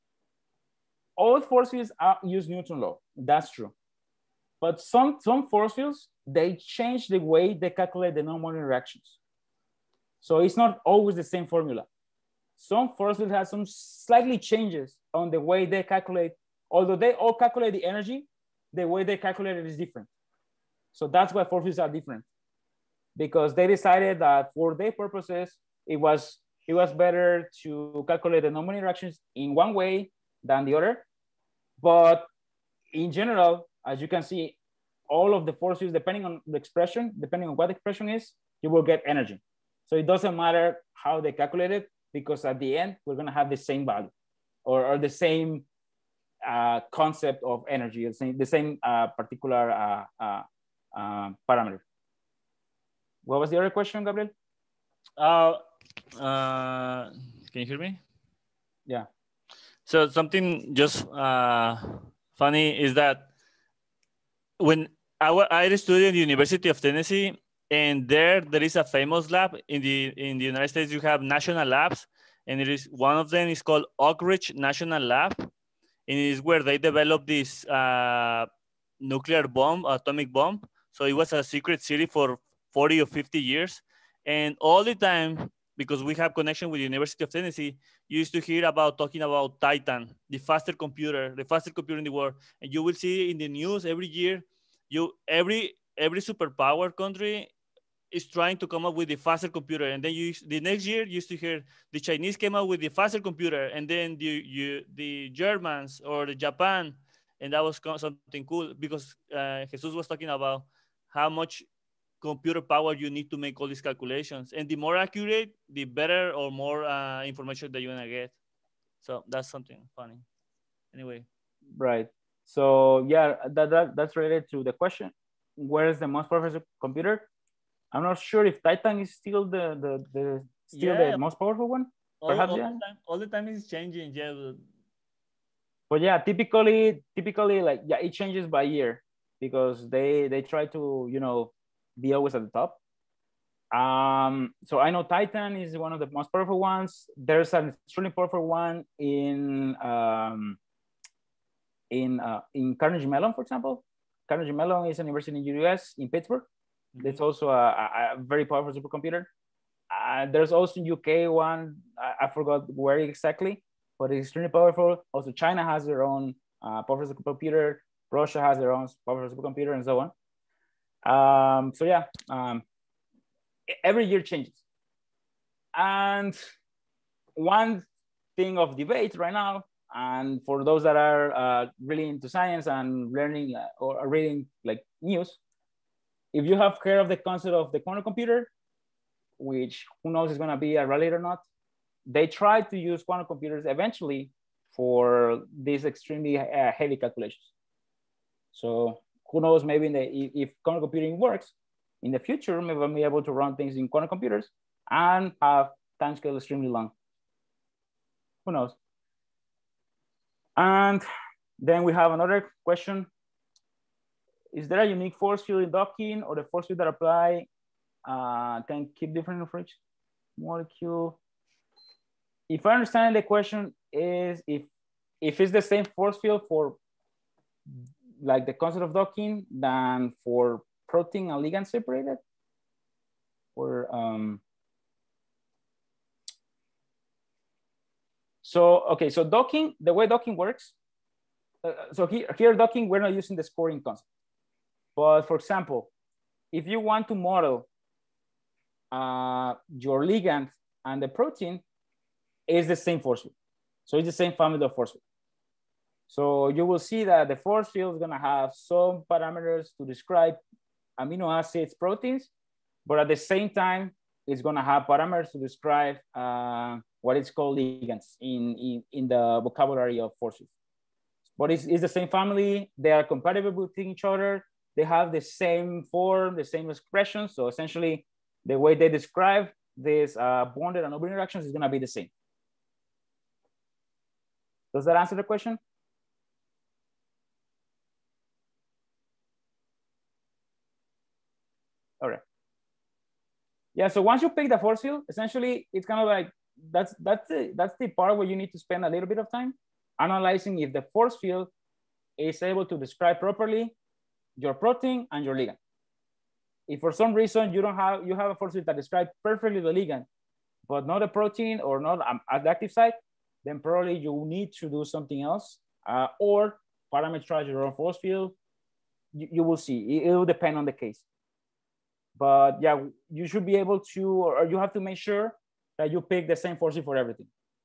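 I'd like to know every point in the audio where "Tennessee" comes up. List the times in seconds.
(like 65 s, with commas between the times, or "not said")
66 s, 87 s.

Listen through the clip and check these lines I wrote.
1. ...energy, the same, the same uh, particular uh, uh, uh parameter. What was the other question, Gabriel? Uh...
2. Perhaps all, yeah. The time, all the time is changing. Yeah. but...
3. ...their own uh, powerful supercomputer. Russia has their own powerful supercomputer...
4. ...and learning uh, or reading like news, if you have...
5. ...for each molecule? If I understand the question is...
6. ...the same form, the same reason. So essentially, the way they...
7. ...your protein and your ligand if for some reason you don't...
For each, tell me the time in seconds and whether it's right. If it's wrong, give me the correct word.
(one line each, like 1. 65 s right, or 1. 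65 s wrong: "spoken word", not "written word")
1. 47 s right
2. 132 s right
3. 165 s right
4. 182 s right
5. 219 s right
6. 275 s wrong: "expression", not "reason"
7. 304 s right.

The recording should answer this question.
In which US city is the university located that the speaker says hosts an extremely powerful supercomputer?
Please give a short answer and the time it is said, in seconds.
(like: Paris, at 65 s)
Pittsburgh, at 156 s.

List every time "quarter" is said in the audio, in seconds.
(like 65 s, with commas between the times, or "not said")
not said.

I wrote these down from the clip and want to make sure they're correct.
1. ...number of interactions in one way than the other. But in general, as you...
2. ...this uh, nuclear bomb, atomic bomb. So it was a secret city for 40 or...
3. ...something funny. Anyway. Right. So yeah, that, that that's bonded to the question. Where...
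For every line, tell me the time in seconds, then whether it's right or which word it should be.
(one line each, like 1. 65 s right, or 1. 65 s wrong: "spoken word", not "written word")
1. 28 s right
2. 77 s right
3. 119 s wrong: "related", not "bonded".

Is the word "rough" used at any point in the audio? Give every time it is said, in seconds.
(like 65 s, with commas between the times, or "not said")
not said.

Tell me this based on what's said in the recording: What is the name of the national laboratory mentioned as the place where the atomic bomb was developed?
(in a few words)
Oak Ridge National Lab.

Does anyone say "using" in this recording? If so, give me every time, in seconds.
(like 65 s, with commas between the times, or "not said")
243 s.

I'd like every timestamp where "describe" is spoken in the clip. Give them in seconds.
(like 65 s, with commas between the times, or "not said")
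259 s, 265 s, 278 s, 302 s, 308 s.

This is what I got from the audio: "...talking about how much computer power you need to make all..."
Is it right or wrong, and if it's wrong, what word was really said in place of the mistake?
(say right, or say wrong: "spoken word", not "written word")
right.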